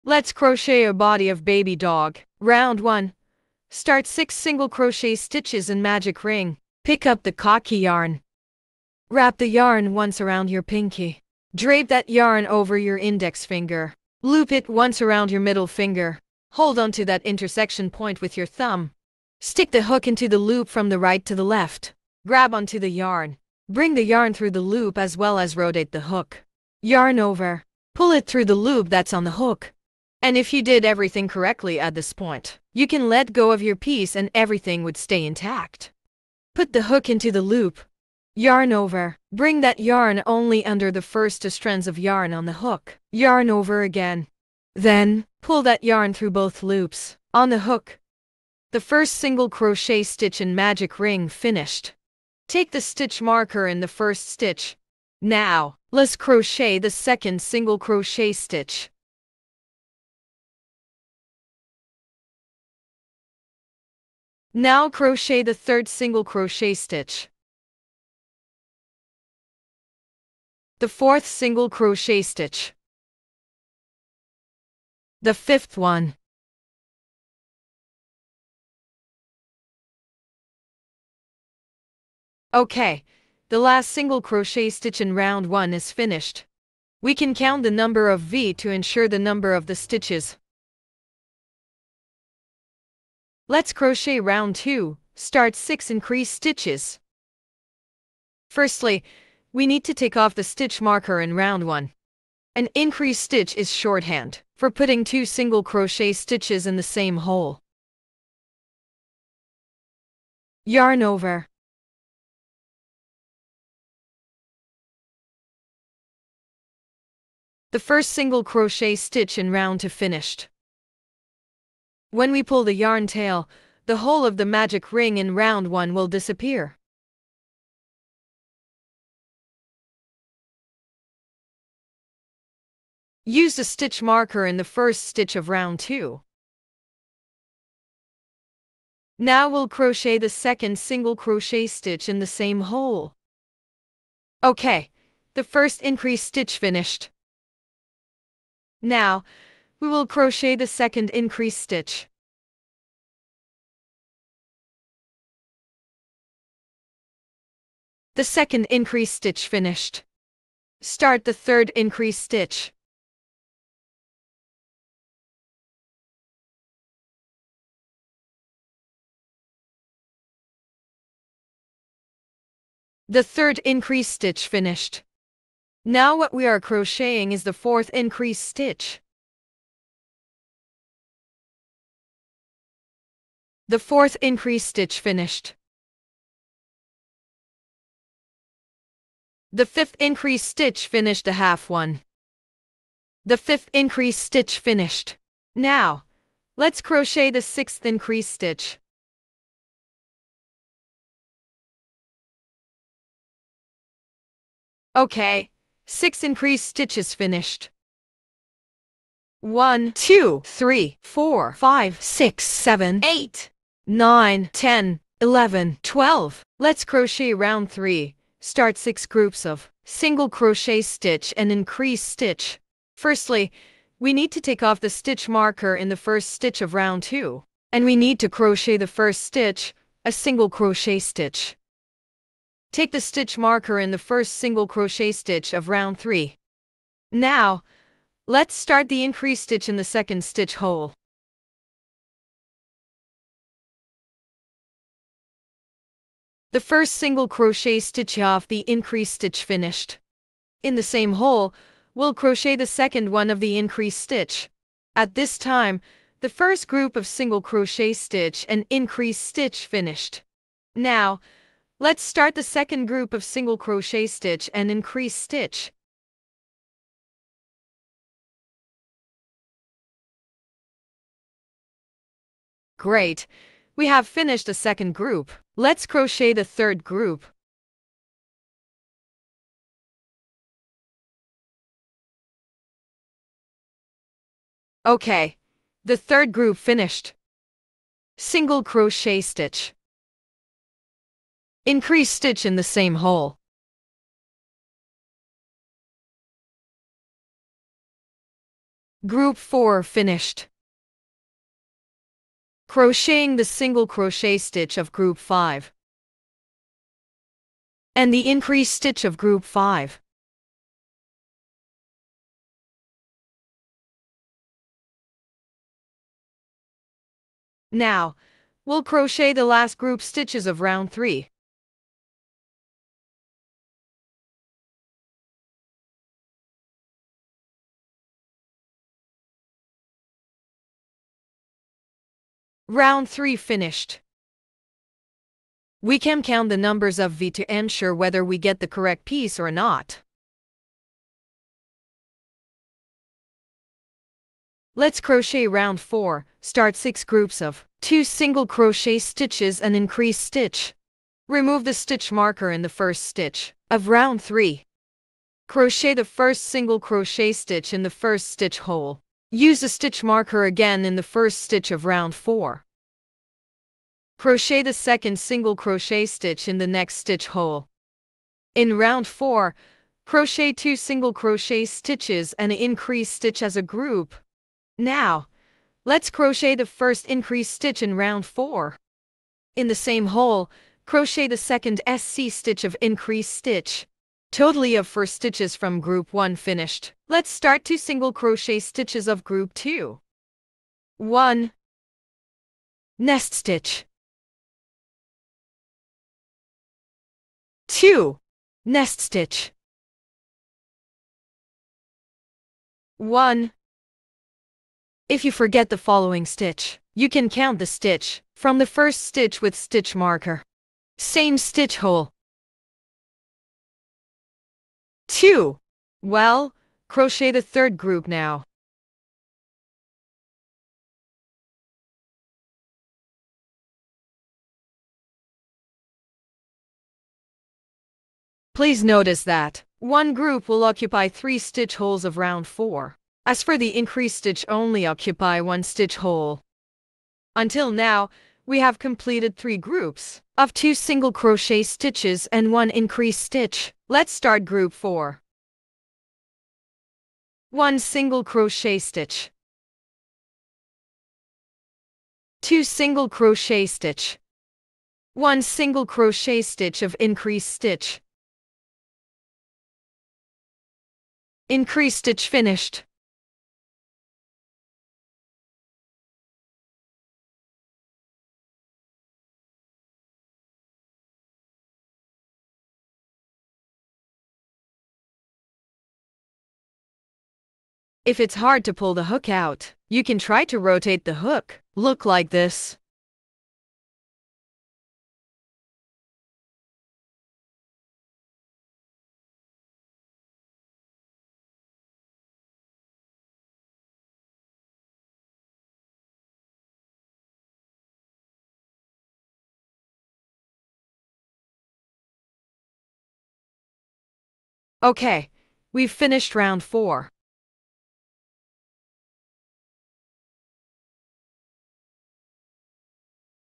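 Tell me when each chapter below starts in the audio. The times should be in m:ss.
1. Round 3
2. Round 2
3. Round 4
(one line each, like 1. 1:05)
1. 3:37
2. 1:34
3. 5:45.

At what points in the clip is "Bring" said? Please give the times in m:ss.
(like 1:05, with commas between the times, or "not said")
0:23, 0:39.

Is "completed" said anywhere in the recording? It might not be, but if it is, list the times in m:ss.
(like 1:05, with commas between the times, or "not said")
7:18.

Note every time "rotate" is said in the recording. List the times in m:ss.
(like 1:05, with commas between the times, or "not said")
0:25, 8:00.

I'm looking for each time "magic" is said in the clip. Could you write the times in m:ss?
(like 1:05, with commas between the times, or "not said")
0:05, 0:50, 2:04.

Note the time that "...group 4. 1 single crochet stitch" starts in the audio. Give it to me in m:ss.
7:24.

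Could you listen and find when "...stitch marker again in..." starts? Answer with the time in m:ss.
5:59.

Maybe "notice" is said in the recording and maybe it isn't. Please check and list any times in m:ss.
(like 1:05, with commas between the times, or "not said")
7:08.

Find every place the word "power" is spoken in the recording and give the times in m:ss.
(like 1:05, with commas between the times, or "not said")
not said.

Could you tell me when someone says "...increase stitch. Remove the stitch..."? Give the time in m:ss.
5:49.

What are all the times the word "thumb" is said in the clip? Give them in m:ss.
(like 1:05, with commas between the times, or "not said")
0:18.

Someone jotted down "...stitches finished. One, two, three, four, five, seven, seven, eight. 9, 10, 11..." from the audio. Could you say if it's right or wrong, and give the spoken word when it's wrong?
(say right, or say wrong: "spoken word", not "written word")
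wrong: "six", not "seven".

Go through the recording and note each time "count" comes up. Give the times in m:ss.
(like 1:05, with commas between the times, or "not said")
1:27, 5:36, 6:47.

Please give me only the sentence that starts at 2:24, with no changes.
Okay, the first increase stitch finished.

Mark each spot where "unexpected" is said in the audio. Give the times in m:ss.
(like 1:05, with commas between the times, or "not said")
not said.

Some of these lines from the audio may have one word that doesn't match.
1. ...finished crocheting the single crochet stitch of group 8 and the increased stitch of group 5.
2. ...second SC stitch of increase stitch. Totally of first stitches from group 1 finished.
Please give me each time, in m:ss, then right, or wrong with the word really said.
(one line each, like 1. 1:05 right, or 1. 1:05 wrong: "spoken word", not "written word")
1. 4:59 wrong: "5", not "8"
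2. 6:21 right.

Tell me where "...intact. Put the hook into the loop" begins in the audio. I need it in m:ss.
0:35.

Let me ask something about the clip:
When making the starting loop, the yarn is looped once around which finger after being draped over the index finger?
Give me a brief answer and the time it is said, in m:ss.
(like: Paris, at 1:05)
middle finger, at 0:15.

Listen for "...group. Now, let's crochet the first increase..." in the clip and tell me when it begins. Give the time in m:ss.
6:13.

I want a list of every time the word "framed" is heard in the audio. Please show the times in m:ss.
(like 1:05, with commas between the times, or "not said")
not said.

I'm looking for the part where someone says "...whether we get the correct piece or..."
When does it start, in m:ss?
5:37.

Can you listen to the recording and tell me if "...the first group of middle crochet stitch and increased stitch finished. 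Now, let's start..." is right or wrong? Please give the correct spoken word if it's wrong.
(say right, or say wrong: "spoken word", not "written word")
wrong: "single", not "middle".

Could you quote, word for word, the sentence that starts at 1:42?
An increase stitch is shorthand for putting two single crochet stitches in the same hole.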